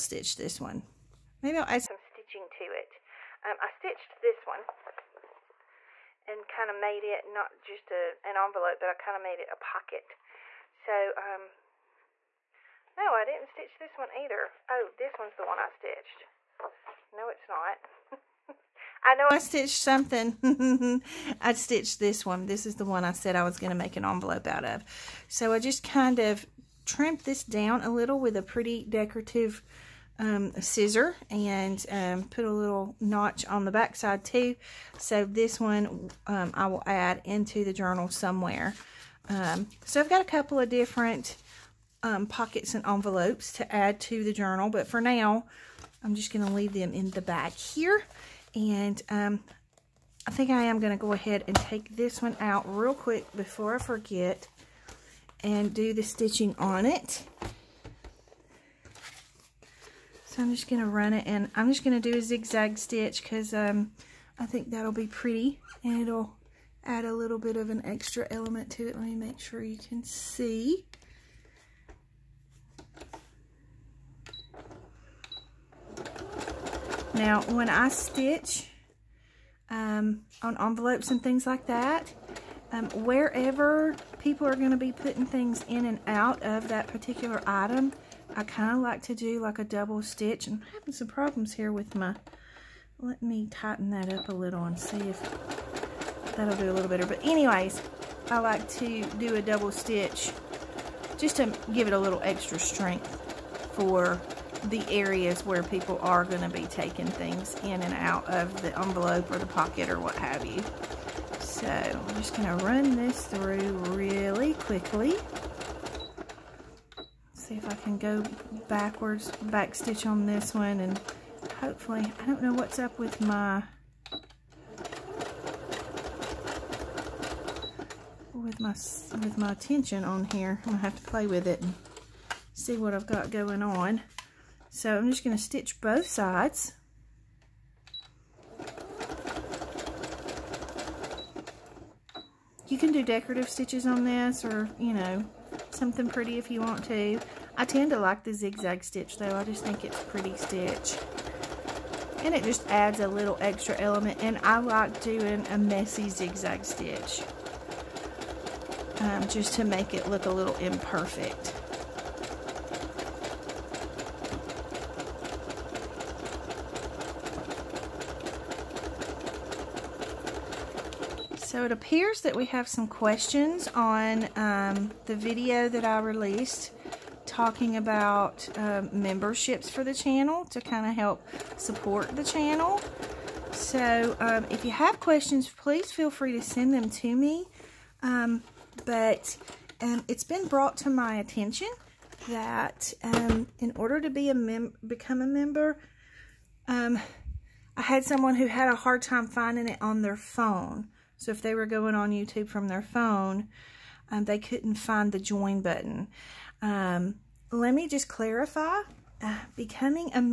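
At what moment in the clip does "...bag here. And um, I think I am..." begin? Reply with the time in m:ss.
0:47.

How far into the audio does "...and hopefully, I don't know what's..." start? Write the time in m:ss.
2:00.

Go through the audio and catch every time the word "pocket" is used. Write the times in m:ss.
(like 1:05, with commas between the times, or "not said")
0:09, 0:42, 1:49.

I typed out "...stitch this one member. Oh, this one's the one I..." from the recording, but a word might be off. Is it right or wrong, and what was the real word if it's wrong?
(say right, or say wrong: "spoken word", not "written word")
wrong: "either", not "member".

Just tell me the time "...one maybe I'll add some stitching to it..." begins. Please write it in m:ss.
0:00.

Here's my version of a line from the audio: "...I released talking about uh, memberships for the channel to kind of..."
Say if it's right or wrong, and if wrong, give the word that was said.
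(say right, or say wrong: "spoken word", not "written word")
right.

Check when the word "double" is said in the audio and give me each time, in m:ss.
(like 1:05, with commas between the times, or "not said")
1:29, 1:39.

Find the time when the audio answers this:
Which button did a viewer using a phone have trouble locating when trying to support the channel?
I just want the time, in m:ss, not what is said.
3:25.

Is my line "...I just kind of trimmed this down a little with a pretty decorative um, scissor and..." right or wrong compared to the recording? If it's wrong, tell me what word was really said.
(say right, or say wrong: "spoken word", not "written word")
right.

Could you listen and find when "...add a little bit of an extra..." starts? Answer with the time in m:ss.
1:06.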